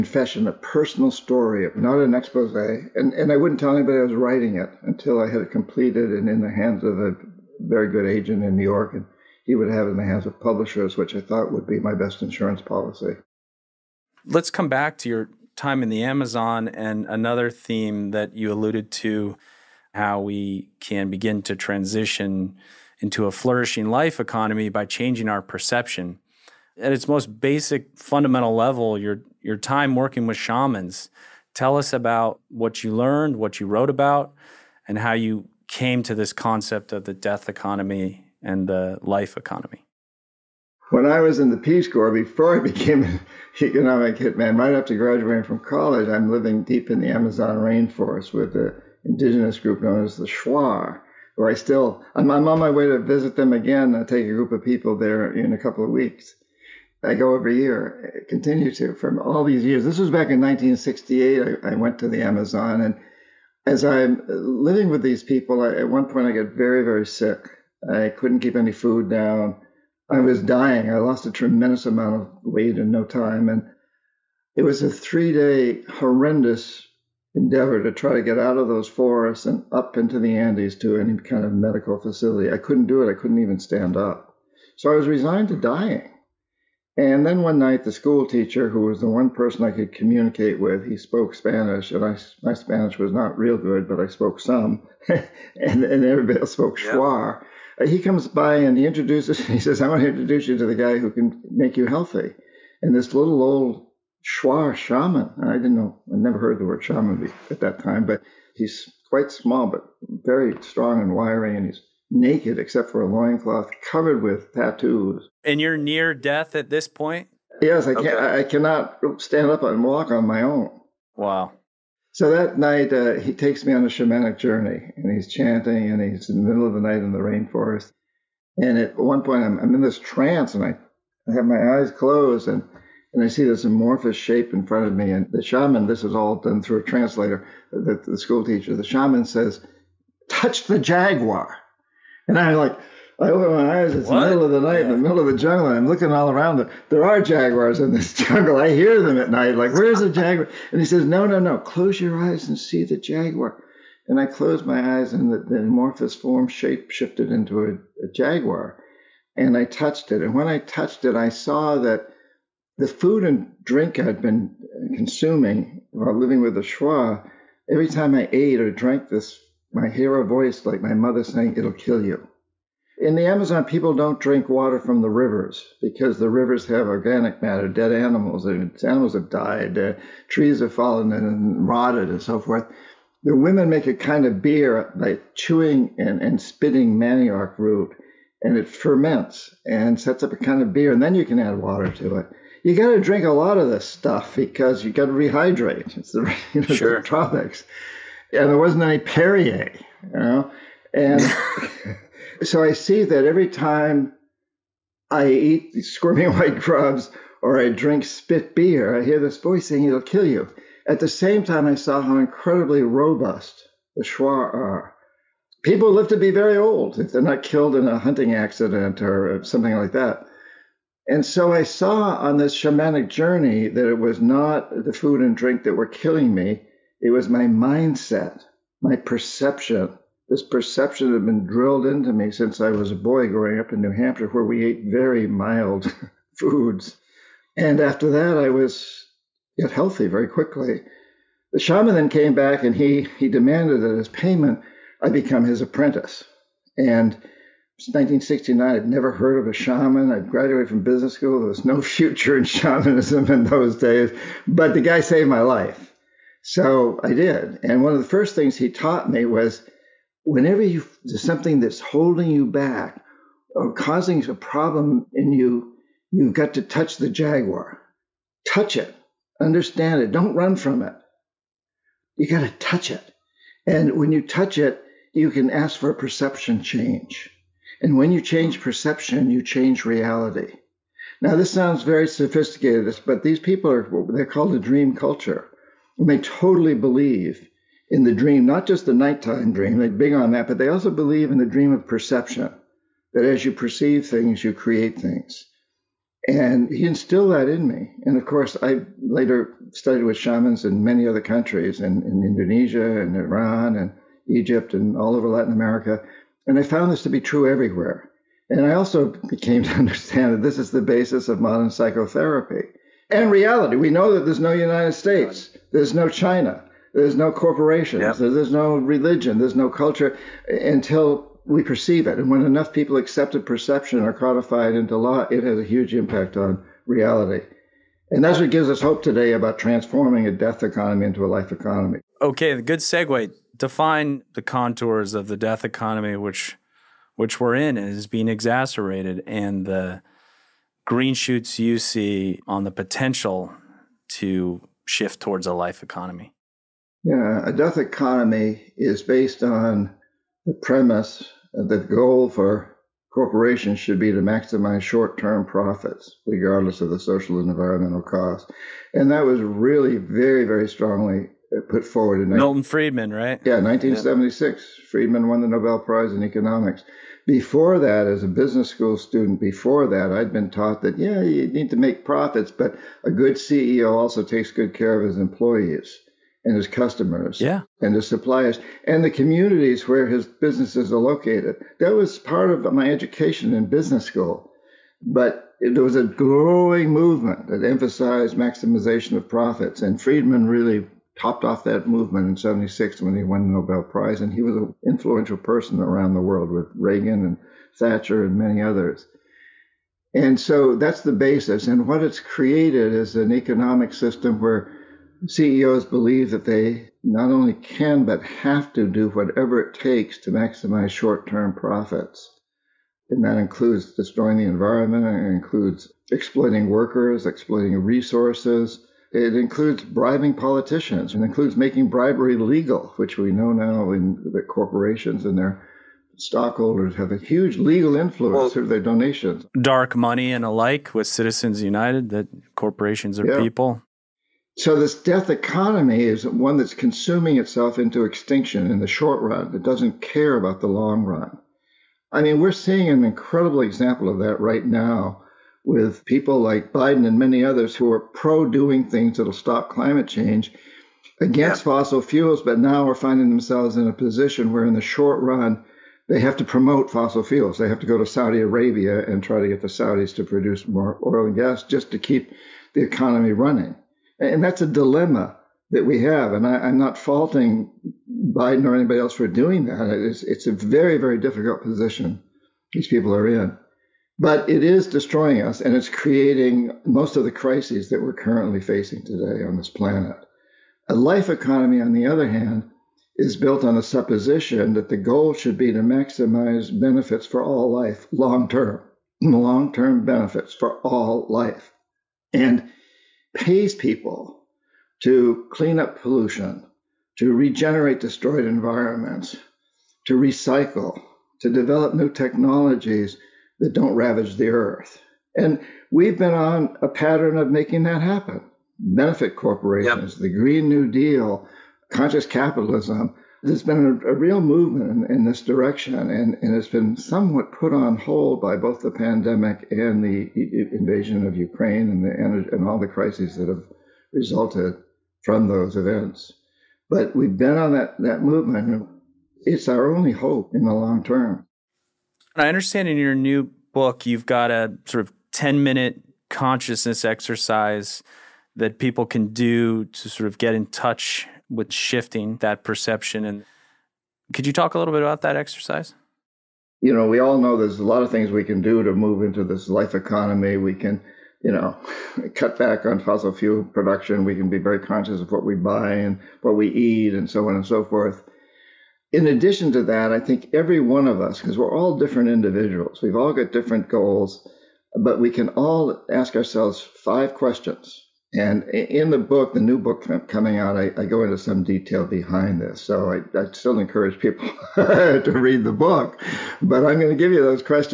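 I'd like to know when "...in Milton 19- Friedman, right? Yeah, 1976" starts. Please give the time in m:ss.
6:02.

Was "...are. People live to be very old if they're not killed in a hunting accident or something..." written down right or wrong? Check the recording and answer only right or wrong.
right.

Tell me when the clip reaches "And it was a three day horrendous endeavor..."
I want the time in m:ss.
1:13.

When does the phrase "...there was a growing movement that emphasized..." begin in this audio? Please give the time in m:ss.
6:25.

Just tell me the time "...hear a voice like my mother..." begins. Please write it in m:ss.
2:49.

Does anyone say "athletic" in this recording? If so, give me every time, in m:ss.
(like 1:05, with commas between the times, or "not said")
not said.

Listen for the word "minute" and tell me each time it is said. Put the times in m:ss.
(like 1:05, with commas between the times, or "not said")
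8:55.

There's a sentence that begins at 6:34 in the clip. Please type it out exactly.
And he was an influential person around the world with Reagan and Thatcher and many others.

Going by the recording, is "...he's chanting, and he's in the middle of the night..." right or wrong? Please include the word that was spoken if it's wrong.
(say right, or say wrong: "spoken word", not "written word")
right.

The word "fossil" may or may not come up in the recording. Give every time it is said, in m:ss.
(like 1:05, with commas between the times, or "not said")
7:31, 7:36, 9:12.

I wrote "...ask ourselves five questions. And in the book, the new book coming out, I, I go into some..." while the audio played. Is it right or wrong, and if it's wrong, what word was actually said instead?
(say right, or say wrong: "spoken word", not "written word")
right.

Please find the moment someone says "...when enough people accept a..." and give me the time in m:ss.
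5:22.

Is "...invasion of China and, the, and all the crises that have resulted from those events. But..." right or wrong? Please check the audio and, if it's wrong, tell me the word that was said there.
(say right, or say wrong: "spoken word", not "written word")
wrong: "Ukraine", not "China".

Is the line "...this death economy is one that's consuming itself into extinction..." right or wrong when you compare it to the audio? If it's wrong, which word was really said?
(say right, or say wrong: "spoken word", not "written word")
right.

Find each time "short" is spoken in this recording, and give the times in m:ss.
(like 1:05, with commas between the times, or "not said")
5:54, 6:50, 7:18, 7:34.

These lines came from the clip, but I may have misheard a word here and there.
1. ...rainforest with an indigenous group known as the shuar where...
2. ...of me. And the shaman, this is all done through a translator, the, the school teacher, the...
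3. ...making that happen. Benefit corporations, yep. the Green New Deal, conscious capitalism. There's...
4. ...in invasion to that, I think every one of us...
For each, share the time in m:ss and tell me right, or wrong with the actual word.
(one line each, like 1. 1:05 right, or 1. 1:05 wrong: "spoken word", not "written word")
1. 0:47 right
2. 2:14 right
3. 8:27 right
4. 9:19 wrong: "addition", not "invasion".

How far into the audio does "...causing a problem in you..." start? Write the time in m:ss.
4:23.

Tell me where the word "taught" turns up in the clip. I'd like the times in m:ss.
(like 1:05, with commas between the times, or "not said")
4:18, 6:10.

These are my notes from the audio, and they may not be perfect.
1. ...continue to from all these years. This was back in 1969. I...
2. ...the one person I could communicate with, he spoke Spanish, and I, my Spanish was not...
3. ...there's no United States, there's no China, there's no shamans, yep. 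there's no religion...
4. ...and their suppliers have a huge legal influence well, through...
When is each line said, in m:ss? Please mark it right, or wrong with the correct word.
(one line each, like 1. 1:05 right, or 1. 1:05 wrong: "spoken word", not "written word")
1. 0:58 wrong: "1968", not "1969"
2. 1:29 right
3. 5:14 wrong: "corporations", not "shamans"
4. 7:05 wrong: "stockholders", not "suppliers".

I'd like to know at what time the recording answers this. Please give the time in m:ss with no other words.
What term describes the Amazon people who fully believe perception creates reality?
4:44.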